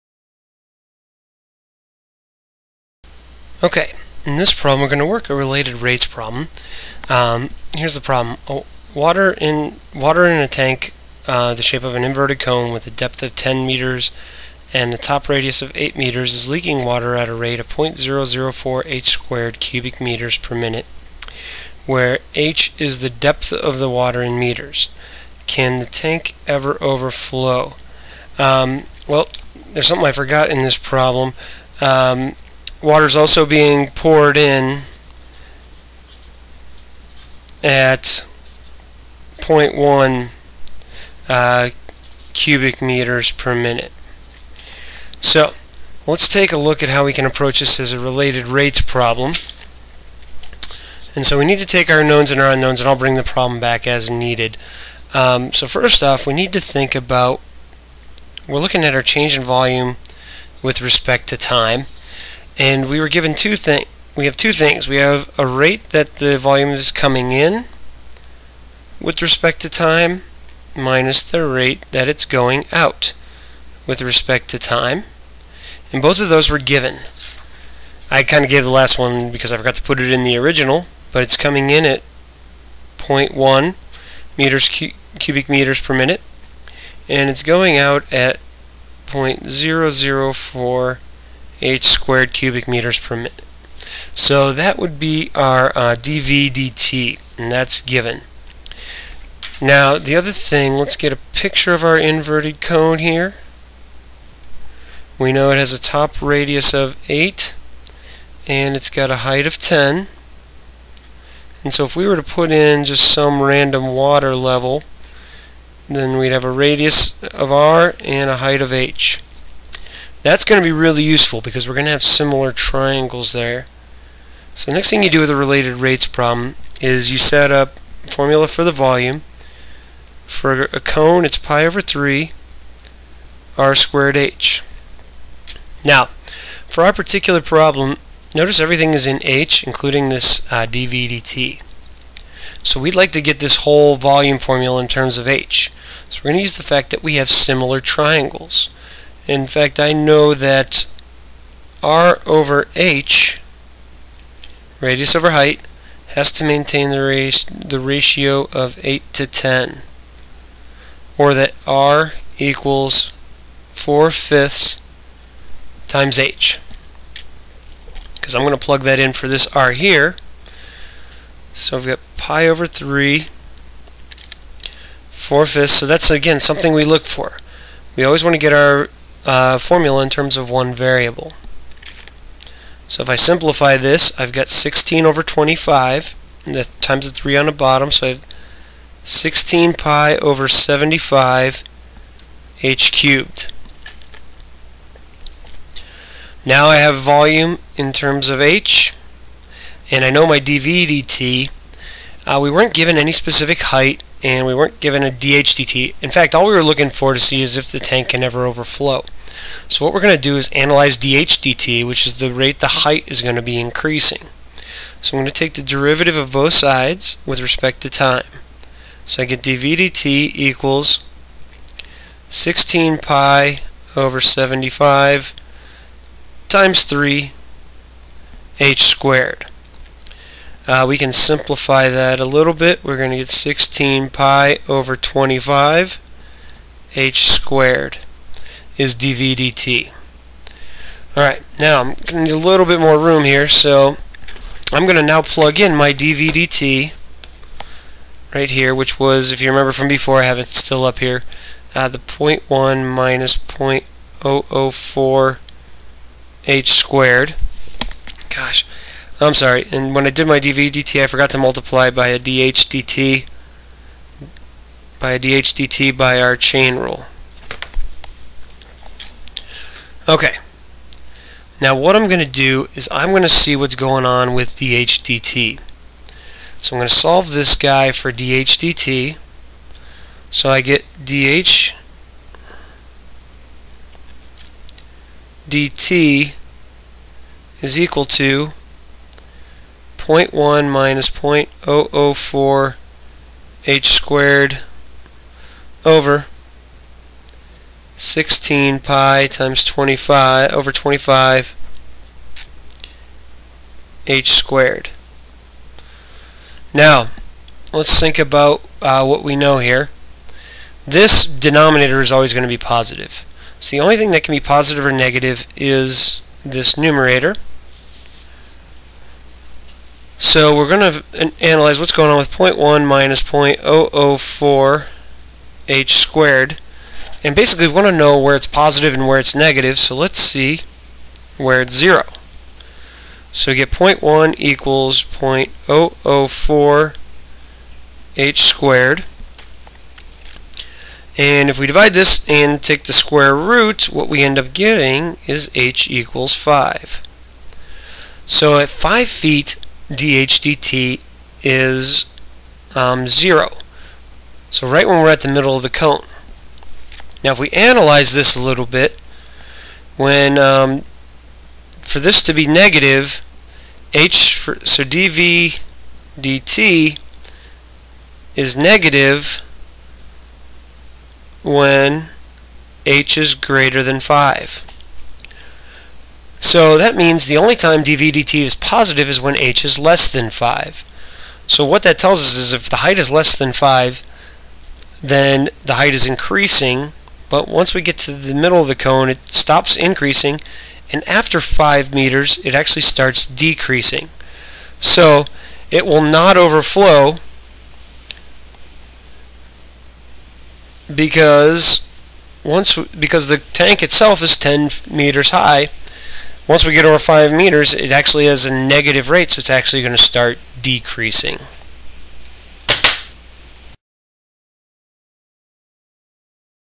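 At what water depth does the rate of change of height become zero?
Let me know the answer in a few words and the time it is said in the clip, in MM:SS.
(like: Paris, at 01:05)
5, at 05:45.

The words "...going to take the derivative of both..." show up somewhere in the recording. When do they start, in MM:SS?
03:35.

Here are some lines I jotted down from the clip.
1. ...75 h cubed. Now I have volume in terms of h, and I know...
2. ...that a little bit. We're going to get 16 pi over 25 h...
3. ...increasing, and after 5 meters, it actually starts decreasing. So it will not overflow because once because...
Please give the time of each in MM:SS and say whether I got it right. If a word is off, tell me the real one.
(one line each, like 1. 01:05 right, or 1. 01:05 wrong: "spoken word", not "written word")
1. 03:10 right
2. 03:51 right
3. 06:29 right.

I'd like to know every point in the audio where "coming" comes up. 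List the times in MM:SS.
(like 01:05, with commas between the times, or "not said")
01:06, 01:21.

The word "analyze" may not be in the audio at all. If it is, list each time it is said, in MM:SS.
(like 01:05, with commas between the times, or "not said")
03:30, 05:21, 05:57.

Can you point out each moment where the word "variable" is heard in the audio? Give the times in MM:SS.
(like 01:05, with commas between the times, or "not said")
03:00.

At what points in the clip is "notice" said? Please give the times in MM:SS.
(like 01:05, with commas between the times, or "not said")
02:18.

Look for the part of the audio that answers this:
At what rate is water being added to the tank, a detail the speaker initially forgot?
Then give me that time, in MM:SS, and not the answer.
00:39.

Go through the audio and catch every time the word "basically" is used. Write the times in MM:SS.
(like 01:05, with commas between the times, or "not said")
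05:27.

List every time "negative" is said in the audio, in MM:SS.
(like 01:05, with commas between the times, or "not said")
05:14, 05:29, 06:02, 06:08, 06:48.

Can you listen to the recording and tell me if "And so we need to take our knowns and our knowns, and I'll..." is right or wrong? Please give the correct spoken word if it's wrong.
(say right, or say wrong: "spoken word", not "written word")
wrong: "unknowns", not "knowns".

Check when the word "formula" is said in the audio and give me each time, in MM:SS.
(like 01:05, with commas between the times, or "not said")
02:08, 02:24, 02:59.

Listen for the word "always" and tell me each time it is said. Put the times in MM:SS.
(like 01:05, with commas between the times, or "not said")
02:58, 05:12.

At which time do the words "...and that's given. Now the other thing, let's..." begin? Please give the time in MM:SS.
01:37.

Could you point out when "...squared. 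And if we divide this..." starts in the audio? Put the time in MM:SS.
05:38.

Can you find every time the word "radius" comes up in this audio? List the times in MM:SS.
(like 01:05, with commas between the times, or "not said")
00:15, 01:46, 01:56, 02:34.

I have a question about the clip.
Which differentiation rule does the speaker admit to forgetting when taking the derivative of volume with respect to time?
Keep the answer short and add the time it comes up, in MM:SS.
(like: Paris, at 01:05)
chain rule, at 04:26.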